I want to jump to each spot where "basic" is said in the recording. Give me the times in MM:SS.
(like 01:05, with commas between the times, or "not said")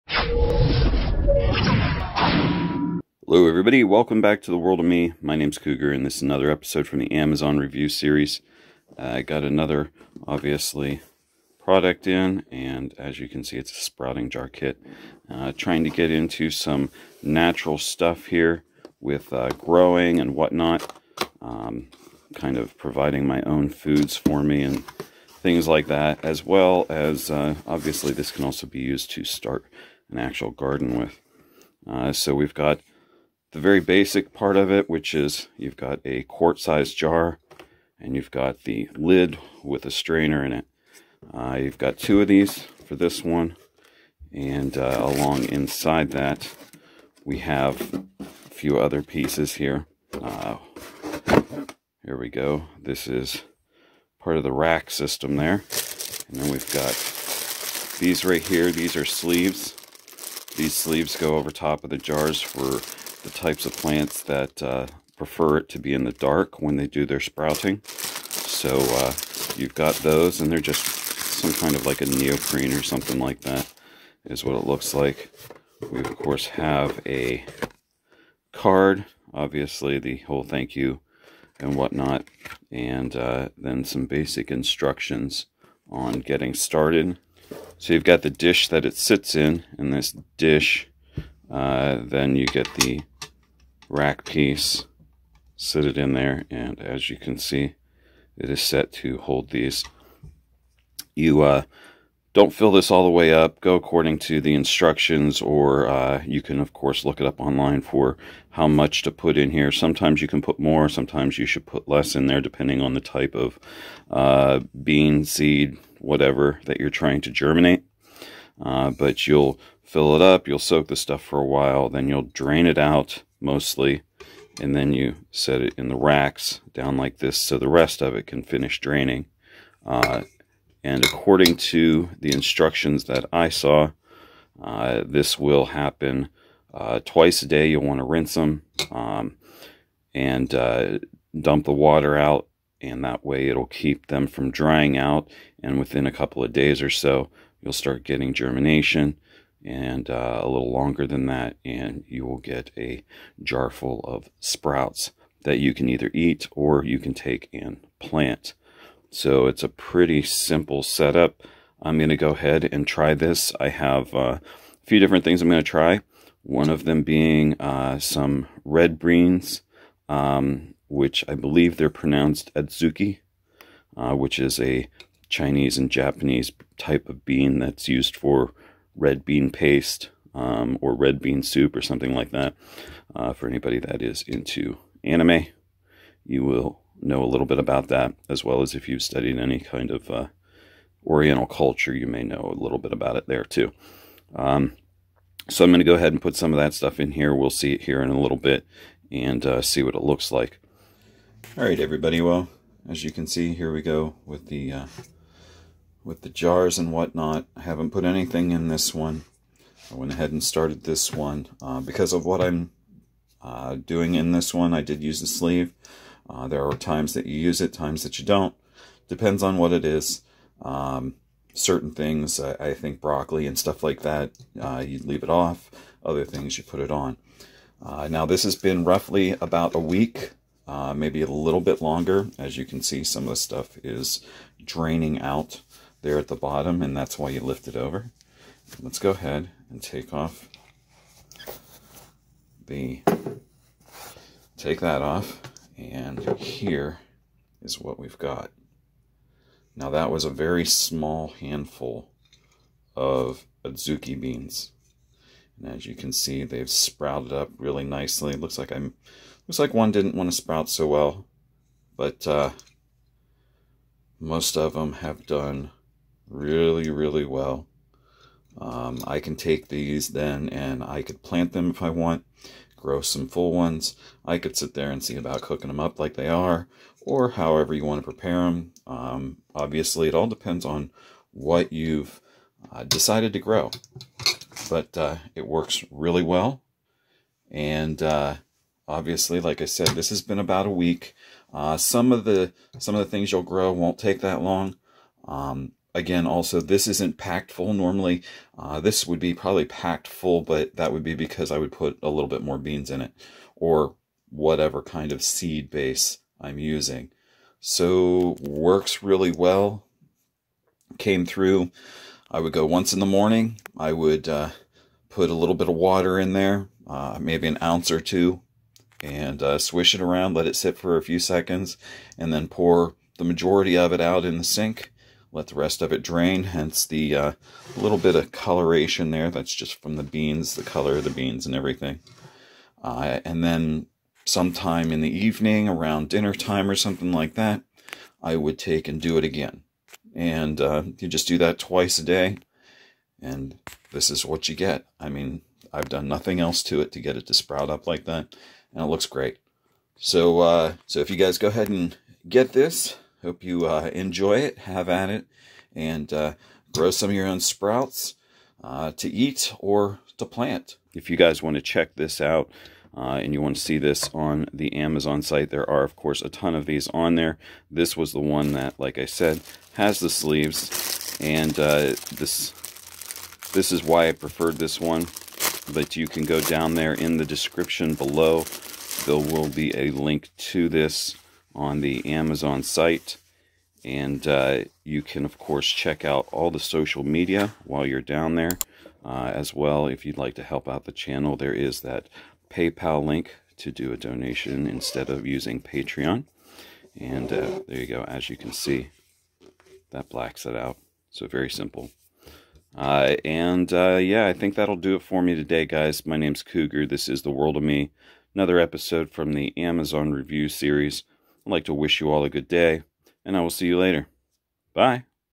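00:33, 01:24.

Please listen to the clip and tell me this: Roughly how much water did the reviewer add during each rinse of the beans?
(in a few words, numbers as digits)
An ounce or two.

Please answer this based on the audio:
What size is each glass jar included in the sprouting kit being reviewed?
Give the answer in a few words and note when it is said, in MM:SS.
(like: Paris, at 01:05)
Quart-sized, at 00:36.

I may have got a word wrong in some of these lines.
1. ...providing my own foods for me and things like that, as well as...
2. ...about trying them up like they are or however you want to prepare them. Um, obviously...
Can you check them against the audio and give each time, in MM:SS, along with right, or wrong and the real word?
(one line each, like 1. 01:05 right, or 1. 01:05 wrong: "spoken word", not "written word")
1. 00:22 right
2. 04:35 wrong: "cooking", not "trying".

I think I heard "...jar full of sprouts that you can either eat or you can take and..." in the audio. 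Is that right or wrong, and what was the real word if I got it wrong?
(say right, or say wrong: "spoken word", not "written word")
right.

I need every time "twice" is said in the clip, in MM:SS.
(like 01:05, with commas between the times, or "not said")
02:17, 05:41.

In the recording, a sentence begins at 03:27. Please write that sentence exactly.
I haven't put anything in this one.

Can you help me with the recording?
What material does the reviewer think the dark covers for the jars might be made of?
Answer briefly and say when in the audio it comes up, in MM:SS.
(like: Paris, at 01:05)
Neoprene, at 01:12.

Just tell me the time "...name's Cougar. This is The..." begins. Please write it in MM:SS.
06:46.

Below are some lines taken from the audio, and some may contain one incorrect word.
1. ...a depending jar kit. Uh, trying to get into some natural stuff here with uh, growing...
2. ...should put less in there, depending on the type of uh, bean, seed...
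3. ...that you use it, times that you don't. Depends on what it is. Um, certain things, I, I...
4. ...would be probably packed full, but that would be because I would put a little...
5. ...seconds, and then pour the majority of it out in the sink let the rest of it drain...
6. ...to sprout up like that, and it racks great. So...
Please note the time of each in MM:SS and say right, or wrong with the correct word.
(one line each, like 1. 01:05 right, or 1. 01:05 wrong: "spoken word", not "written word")
1. 00:13 wrong: "sprouting", not "depending"
2. 01:51 right
3. 03:37 right
4. 04:59 right
5. 05:21 right
6. 05:47 wrong: "looks", not "racks".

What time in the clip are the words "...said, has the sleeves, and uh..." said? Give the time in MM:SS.
06:09.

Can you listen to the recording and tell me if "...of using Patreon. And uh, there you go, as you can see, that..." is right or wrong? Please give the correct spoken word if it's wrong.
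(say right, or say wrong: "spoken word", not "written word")
right.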